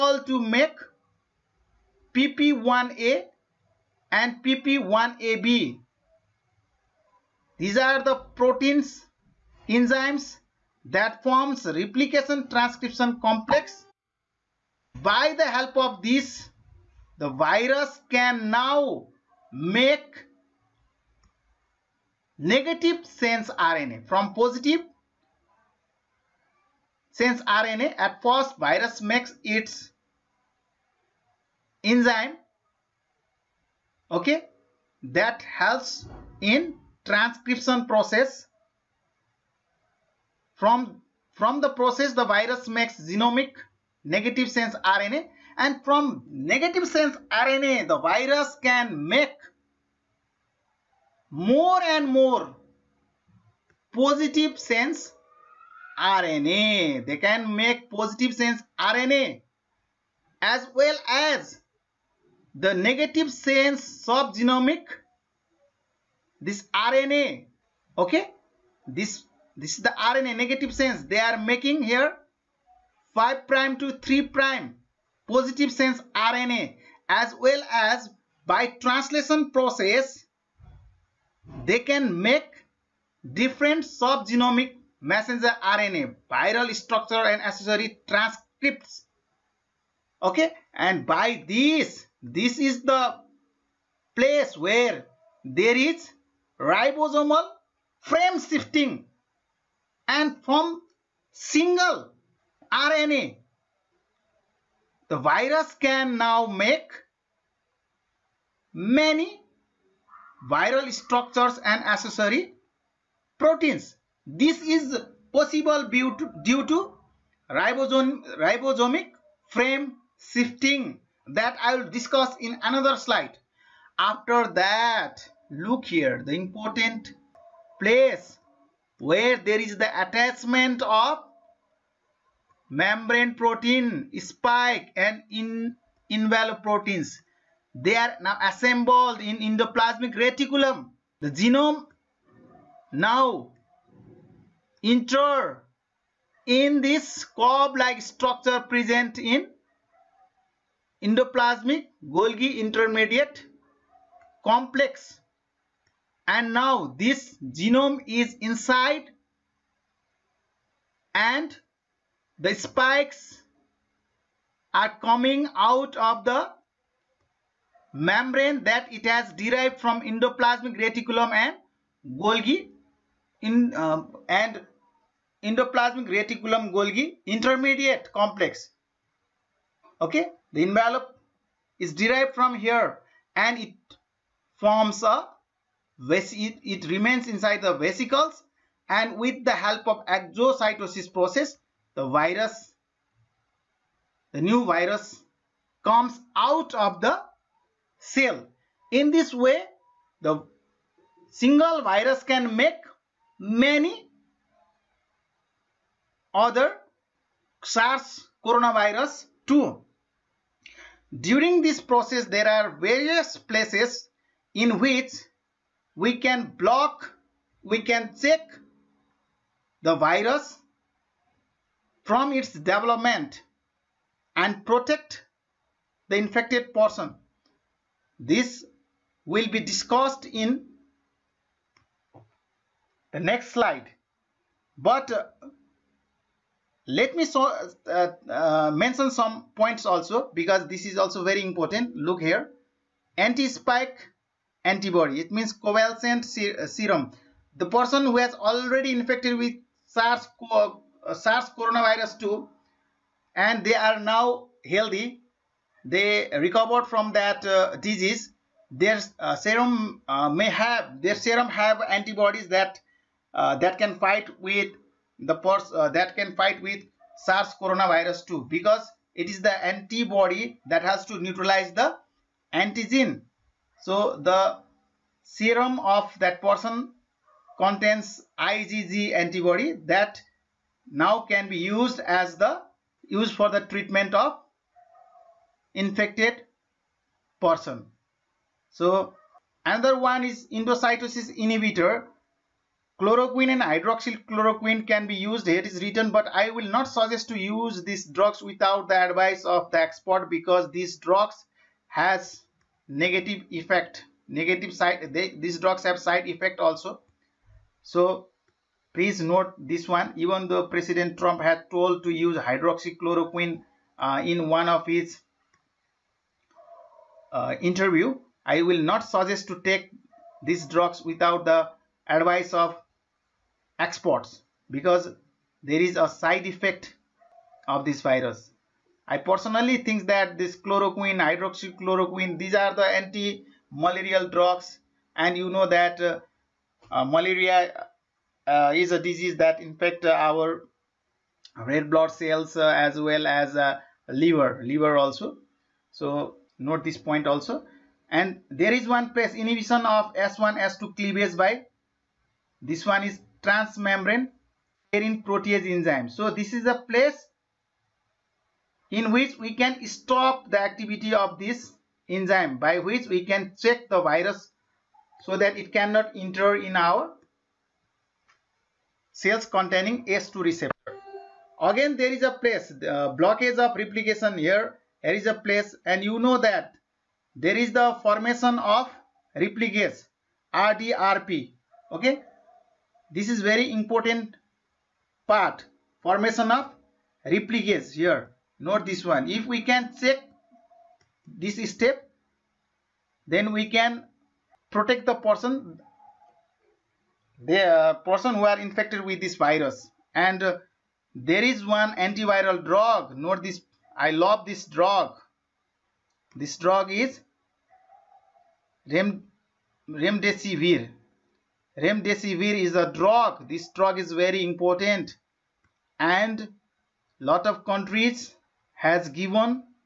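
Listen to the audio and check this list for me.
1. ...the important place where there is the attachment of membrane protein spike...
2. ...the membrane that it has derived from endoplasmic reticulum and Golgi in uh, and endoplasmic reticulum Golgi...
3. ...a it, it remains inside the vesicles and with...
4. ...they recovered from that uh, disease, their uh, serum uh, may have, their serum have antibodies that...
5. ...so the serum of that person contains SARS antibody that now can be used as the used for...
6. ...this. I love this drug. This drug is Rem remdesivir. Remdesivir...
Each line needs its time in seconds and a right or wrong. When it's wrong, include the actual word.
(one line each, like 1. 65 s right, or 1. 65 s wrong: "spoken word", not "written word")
1. 126 s right
2. 166 s right
3. 185 s right
4. 255 s right
5. 273 s wrong: "IgG", not "SARS"
6. 403 s right.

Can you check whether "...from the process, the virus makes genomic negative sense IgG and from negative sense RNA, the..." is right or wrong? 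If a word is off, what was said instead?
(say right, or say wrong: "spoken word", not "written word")
wrong: "RNA", not "IgG".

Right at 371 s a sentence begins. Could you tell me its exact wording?
Again, there is a place, uh, blockage of replication here.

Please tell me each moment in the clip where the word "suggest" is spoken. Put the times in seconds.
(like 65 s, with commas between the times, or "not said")
296 s, 319 s.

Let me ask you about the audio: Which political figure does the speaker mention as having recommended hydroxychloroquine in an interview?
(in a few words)
President Trump.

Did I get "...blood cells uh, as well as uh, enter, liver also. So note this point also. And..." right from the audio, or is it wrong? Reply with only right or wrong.
wrong.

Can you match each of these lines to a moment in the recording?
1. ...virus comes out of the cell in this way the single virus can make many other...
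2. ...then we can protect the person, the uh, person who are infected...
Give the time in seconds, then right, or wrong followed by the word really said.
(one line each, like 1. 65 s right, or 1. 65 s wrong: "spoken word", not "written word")
1. 194 s right
2. 393 s right.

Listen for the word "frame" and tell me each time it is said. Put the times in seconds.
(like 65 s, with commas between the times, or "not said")
98 s, 119 s.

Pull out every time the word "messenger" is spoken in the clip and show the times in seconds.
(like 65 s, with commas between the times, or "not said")
85 s.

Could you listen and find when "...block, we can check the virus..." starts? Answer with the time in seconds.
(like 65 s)
216 s.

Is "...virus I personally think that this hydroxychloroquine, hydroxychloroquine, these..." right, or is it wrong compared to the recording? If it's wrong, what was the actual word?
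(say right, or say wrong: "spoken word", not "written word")
wrong: "chloroquine", not "hydroxychloroquine".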